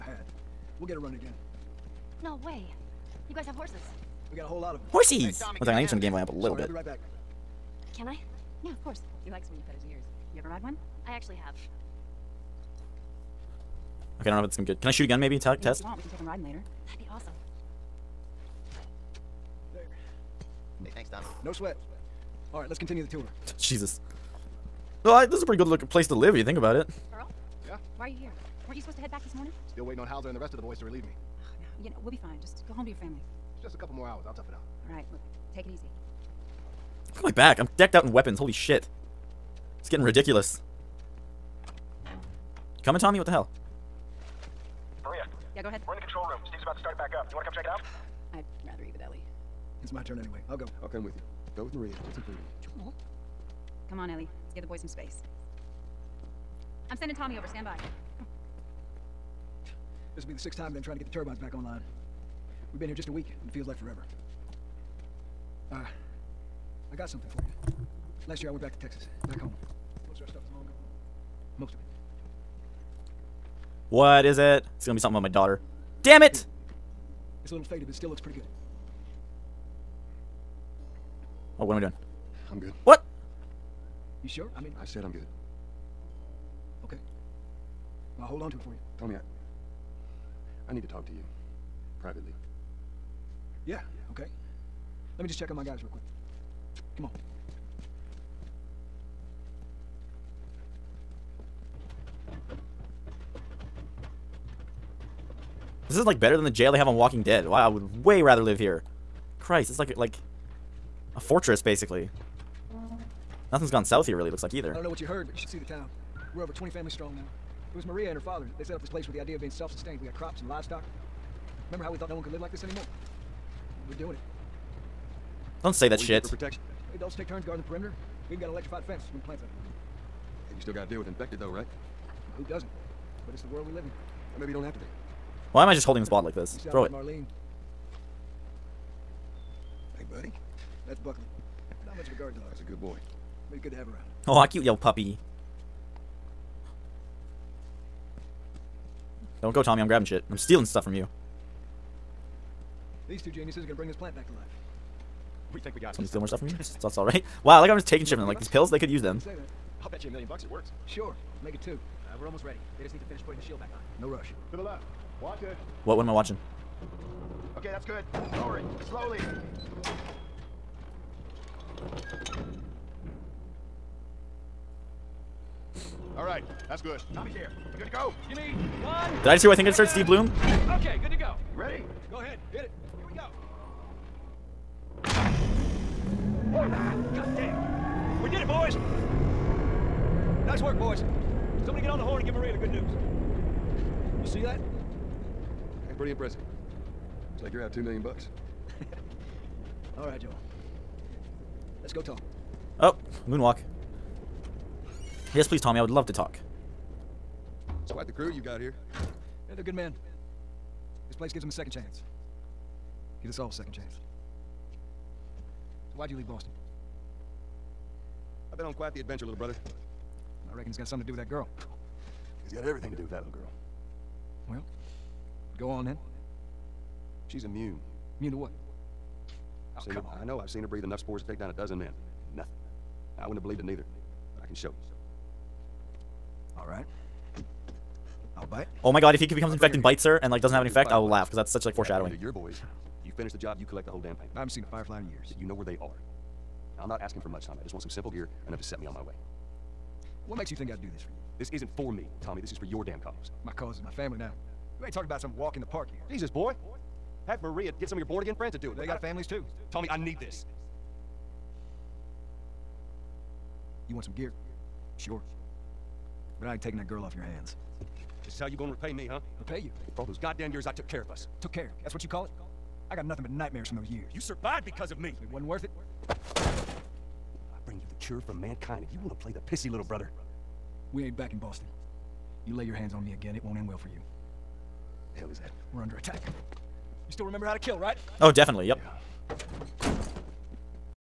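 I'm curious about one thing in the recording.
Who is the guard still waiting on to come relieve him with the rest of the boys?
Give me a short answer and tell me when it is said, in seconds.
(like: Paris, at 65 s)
Hauser, at 30 s.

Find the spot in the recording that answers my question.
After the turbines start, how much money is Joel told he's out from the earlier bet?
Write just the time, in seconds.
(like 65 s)
197 s.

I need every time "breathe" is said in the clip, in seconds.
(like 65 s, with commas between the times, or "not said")
230 s.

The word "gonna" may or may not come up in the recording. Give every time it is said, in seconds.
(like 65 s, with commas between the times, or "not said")
14 s, 74 s, 153 s, 268 s.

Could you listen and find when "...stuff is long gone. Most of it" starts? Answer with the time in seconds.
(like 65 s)
70 s.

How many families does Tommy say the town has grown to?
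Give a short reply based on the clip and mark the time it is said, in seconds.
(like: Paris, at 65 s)
20, at 116 s.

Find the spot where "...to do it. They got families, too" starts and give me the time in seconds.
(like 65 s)
258 s.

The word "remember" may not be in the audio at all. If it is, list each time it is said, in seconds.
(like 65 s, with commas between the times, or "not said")
121 s, 287 s.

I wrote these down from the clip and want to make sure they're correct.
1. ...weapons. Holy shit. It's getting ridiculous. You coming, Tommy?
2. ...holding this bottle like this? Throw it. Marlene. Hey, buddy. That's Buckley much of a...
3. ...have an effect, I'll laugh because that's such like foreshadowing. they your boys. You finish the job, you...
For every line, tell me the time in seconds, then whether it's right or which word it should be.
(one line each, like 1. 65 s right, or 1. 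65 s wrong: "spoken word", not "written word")
1. 38 s right
2. 135 s right
3. 240 s right.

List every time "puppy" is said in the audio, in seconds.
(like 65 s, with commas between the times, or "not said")
144 s.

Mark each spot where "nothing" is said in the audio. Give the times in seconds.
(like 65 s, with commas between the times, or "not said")
113 s, 232 s, 273 s.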